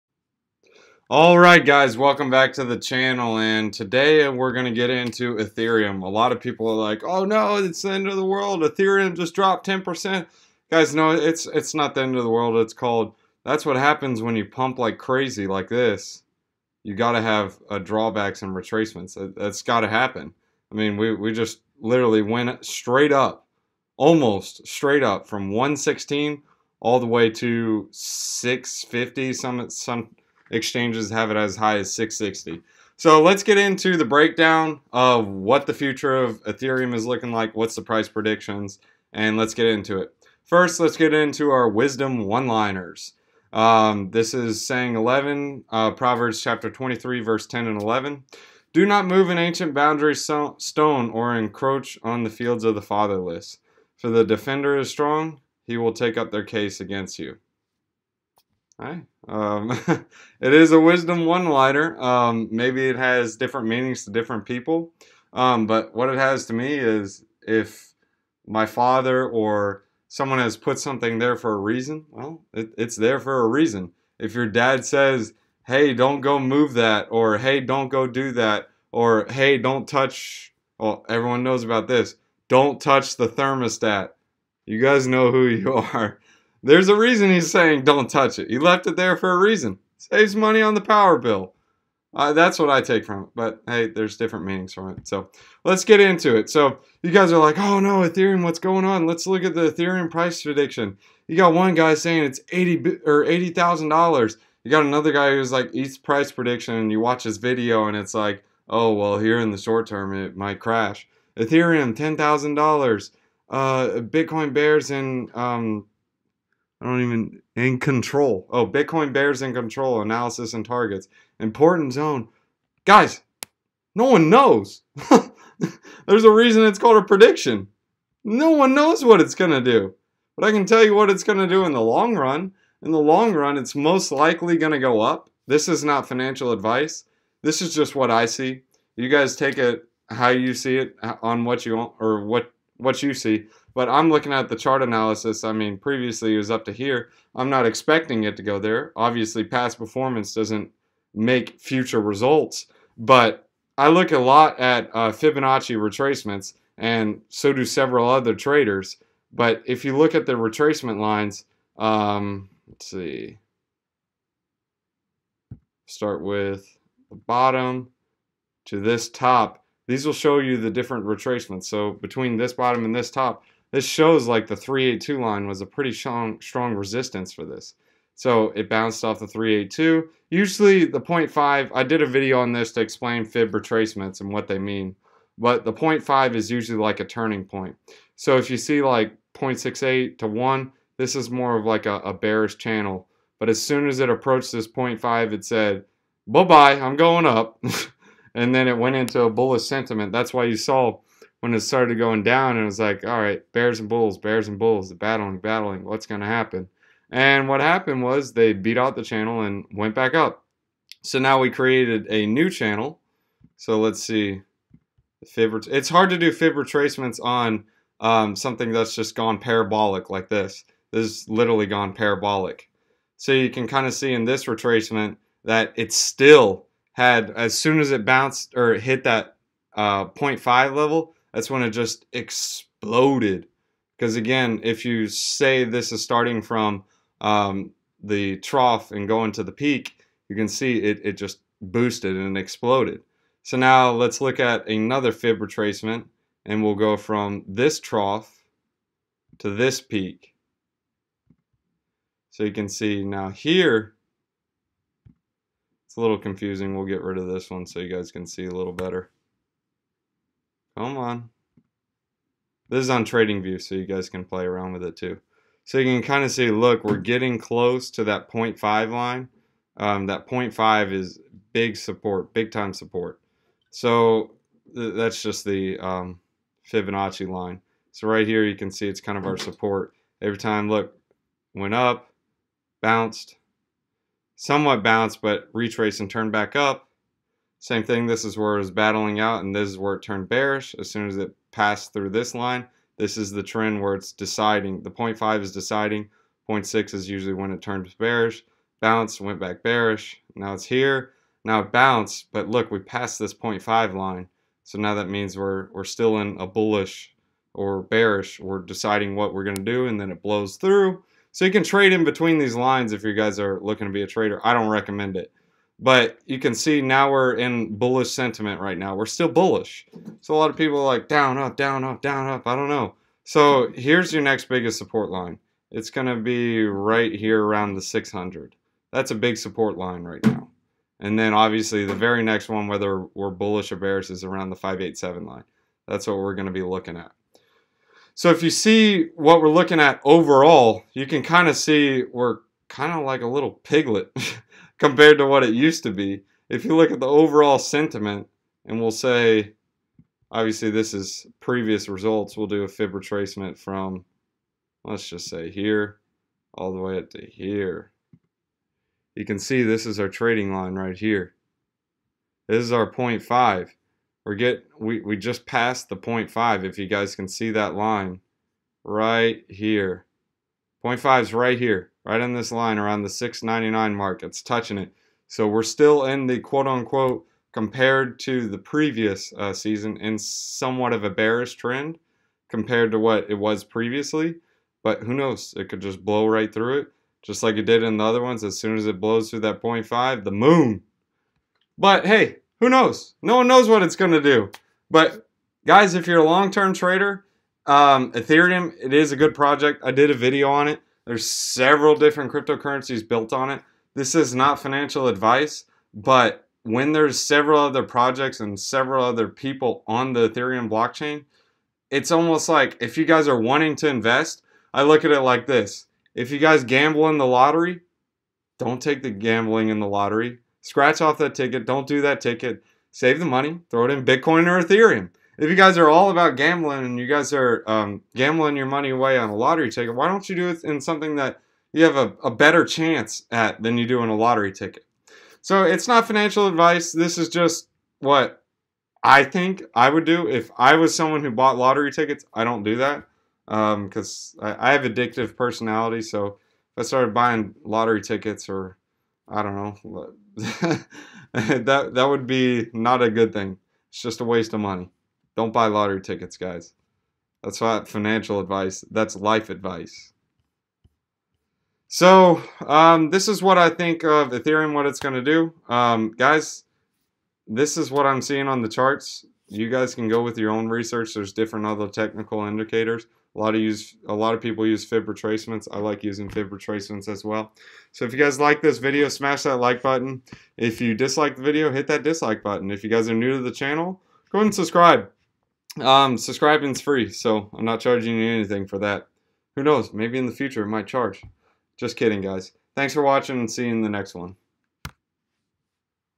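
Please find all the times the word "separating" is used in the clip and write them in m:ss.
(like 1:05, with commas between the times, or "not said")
not said.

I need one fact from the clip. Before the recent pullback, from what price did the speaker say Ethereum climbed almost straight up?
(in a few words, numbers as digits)
116.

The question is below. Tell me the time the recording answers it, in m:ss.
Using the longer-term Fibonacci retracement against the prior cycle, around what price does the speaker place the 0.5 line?
6:13.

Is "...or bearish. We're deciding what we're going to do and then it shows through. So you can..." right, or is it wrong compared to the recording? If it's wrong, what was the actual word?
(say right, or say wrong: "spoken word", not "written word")
wrong: "blows", not "shows".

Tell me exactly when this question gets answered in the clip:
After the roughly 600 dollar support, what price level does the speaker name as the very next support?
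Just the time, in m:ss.
5:34.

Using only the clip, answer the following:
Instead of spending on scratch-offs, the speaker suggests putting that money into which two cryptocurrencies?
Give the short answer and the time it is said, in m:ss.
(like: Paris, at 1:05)
Bitcoin or Ethereum, at 7:04.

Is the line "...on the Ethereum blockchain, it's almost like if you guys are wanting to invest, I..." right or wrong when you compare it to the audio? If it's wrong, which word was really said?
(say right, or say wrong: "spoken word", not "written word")
right.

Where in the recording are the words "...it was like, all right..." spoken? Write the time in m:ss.
3:22.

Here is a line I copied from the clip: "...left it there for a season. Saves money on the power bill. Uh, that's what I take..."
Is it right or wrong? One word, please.
wrong.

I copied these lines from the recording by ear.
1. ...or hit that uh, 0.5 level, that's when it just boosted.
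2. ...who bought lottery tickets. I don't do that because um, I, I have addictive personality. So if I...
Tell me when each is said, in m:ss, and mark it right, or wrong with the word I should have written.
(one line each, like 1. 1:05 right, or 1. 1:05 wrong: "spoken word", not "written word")
1. 3:48 wrong: "exploded", not "boosted"
2. 7:21 right.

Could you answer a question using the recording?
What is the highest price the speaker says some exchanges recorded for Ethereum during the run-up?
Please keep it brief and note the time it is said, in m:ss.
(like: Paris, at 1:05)
660, at 0:31.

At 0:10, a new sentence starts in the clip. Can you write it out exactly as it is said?
Guys, no, it's, it's not the end of the world, it's called, that's what happens when you pump like crazy like this.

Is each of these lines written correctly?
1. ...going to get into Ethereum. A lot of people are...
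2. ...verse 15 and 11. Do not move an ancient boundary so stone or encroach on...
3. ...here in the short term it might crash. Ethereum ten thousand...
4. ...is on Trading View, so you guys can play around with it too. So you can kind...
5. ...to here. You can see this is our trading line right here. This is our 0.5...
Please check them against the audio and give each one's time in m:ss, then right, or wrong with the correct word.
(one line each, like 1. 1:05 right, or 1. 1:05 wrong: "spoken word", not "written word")
1. 0:04 right
2. 0:47 wrong: "10", not "15"
3. 1:49 right
4. 4:22 right
5. 5:57 right.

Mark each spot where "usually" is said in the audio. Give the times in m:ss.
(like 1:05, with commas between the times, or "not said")
3:00, 3:06, 4:57.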